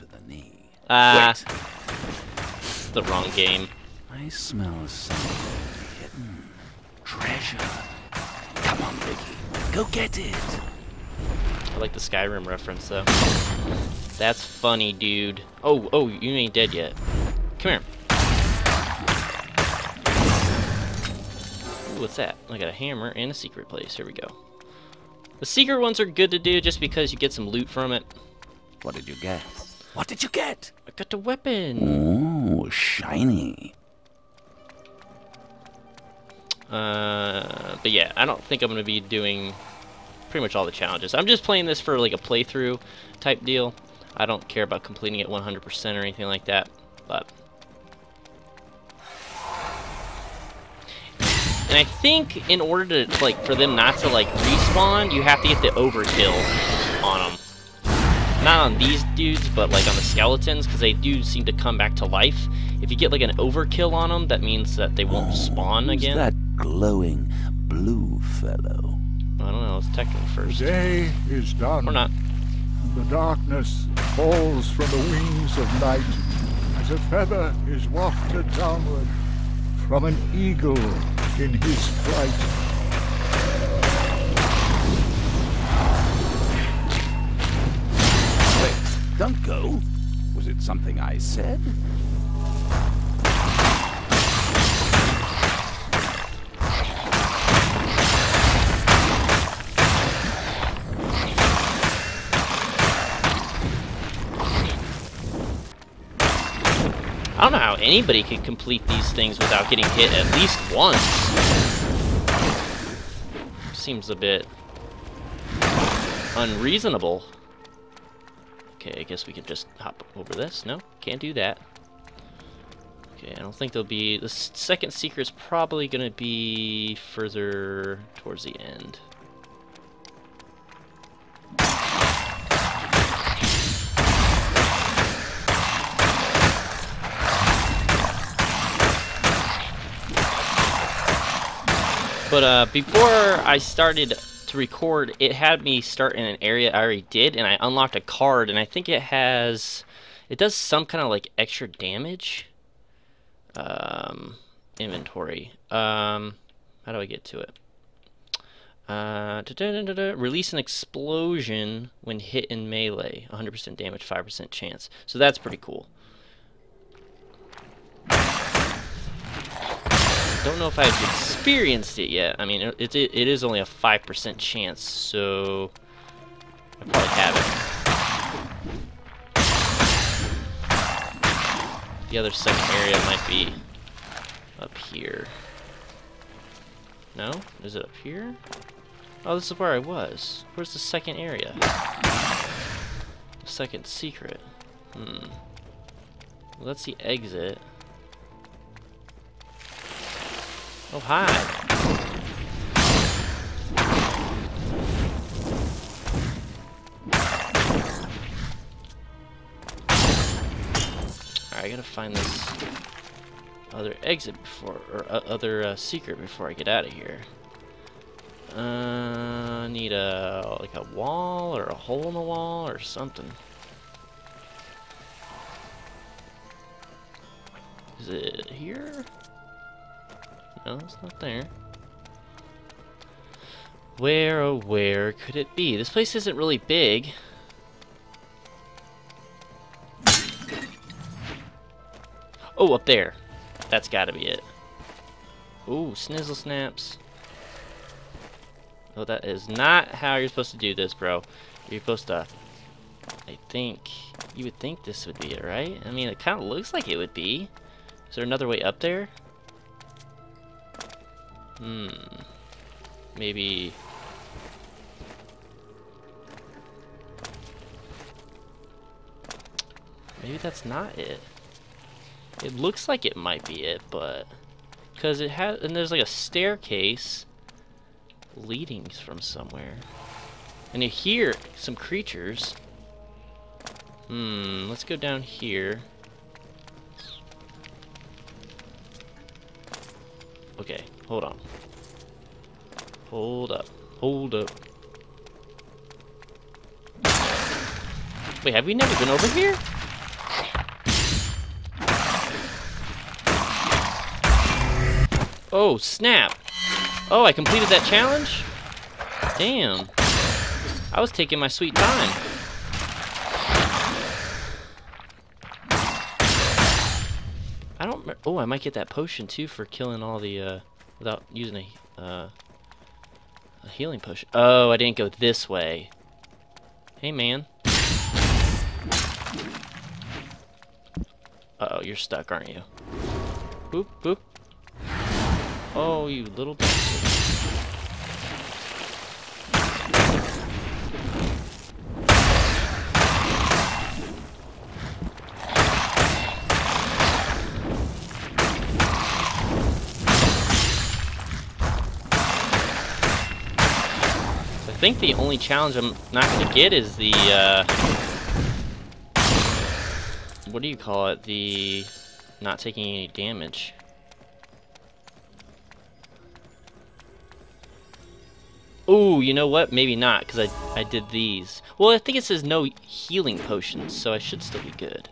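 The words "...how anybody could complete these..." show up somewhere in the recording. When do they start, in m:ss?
1:47.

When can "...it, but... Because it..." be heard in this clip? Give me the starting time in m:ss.
4:33.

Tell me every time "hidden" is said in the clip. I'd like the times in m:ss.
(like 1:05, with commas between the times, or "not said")
0:05.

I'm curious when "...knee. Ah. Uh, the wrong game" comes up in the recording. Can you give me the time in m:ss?
0:00.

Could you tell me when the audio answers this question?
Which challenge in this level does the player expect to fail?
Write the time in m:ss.
6:02.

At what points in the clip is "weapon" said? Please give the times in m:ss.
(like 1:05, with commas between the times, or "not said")
0:31.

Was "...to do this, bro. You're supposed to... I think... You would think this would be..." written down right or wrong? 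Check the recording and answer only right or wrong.
right.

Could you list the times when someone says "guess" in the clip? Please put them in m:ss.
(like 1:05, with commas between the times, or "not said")
1:59.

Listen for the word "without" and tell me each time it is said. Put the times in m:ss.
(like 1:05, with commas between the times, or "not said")
1:49, 5:20.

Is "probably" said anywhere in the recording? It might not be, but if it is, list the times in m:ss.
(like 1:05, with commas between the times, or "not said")
2:05, 2:56.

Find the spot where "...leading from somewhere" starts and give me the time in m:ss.
4:38.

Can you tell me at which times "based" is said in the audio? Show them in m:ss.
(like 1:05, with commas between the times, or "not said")
not said.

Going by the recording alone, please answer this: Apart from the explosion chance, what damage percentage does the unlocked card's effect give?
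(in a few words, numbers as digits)
100%.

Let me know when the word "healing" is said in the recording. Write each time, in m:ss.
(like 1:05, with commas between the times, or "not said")
5:23, 6:12.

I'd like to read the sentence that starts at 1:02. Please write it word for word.
If you get like an overkill on them, that means that they won't oh, spawn again.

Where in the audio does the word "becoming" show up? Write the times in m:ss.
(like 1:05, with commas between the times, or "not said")
not said.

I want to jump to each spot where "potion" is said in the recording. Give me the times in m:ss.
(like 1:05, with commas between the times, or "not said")
5:18, 6:13.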